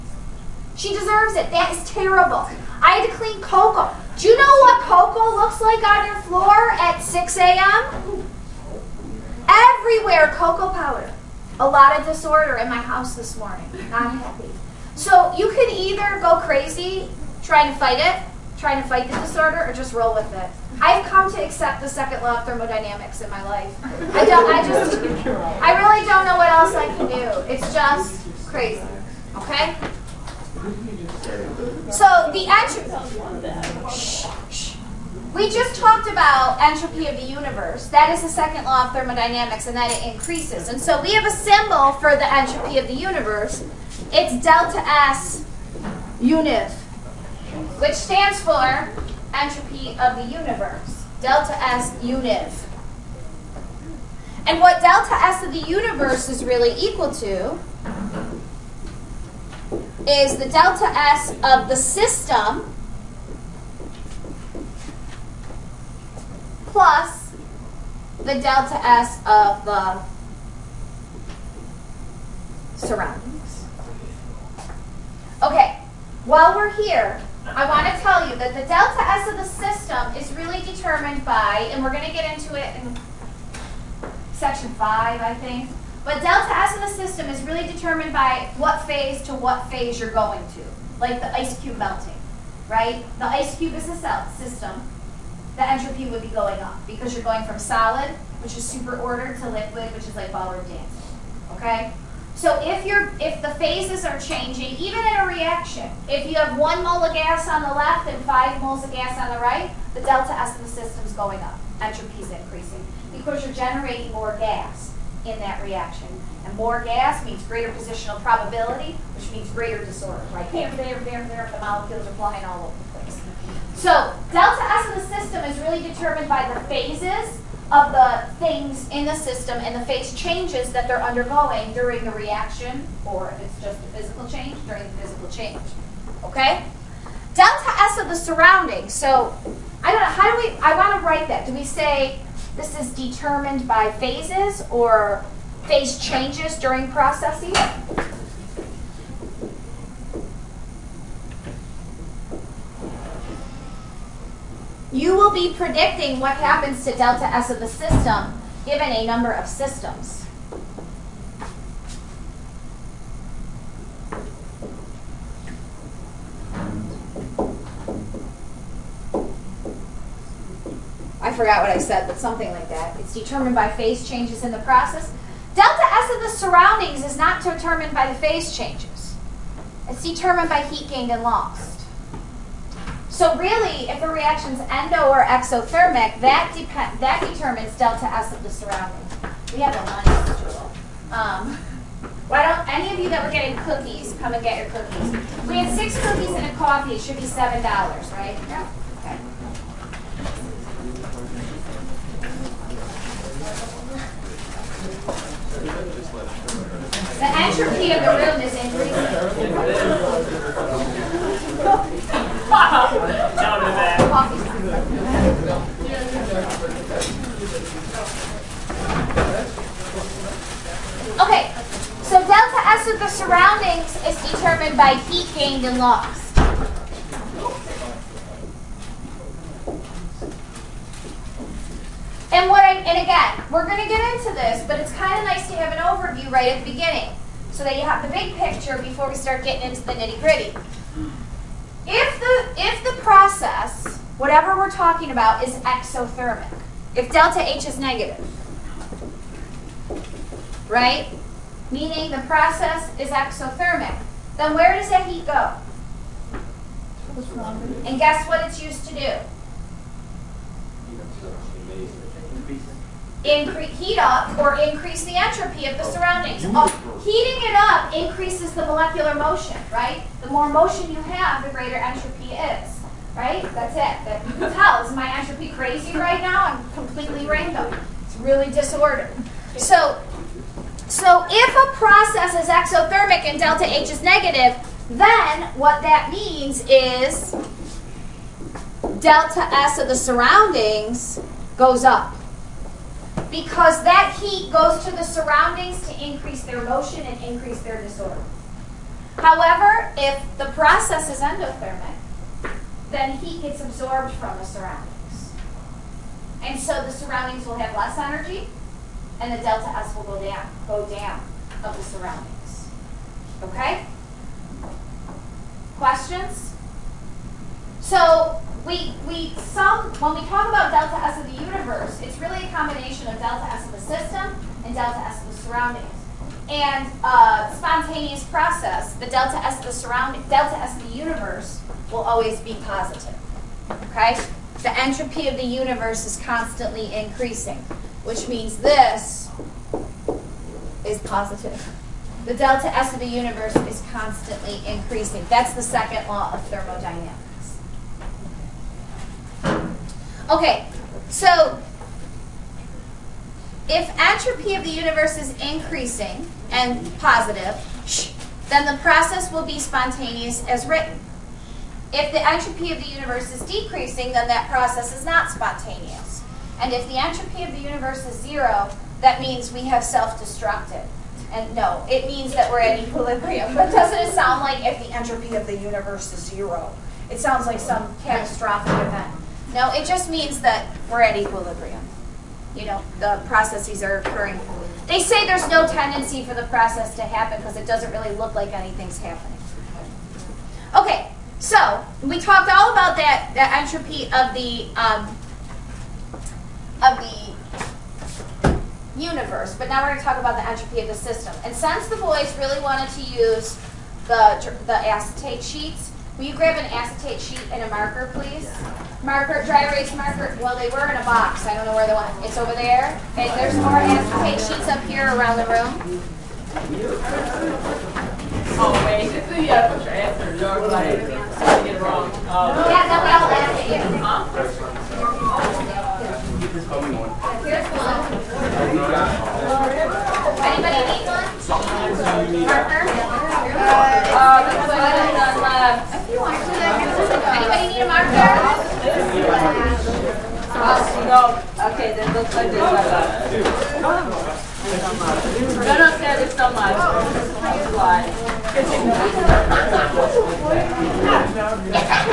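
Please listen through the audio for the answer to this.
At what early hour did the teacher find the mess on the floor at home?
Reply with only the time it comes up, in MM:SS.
00:06.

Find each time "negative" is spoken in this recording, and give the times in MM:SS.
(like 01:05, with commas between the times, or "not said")
04:07, 04:44.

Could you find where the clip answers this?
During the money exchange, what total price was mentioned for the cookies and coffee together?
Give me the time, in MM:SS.
03:17.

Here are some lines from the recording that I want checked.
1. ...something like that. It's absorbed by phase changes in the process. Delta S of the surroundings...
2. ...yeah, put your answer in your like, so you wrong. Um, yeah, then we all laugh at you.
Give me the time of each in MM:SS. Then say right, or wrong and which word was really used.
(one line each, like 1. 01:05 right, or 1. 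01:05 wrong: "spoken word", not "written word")
1. 02:52 wrong: "determined", not "absorbed"
2. 06:59 right.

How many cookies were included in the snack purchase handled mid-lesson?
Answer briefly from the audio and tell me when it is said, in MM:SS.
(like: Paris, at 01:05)
6, at 03:15.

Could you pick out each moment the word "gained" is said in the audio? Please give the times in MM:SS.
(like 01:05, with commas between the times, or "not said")
03:00, 03:45.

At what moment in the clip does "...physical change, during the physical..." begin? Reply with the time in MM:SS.
02:13.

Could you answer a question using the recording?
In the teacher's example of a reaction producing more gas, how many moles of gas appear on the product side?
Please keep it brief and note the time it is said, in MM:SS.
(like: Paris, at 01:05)
5, at 01:48.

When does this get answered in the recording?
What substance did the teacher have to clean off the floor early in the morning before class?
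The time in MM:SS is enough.
00:10.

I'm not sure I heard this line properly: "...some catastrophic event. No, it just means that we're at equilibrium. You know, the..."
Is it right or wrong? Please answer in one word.
right.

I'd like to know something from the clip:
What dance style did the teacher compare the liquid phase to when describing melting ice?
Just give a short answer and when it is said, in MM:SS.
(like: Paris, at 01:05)
ballroom dancing, at 01:40.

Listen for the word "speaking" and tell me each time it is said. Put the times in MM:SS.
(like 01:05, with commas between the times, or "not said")
not said.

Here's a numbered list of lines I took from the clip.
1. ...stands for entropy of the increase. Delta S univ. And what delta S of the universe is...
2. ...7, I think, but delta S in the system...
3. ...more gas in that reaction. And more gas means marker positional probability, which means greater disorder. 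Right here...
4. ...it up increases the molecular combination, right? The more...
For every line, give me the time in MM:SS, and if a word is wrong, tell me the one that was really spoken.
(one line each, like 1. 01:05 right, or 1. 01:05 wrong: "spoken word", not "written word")
1. 00:47 wrong: "universe", not "increase"
2. 01:24 wrong: "5", not "7"
3. 01:54 wrong: "greater", not "marker"
4. 04:27 wrong: "motion", not "combination".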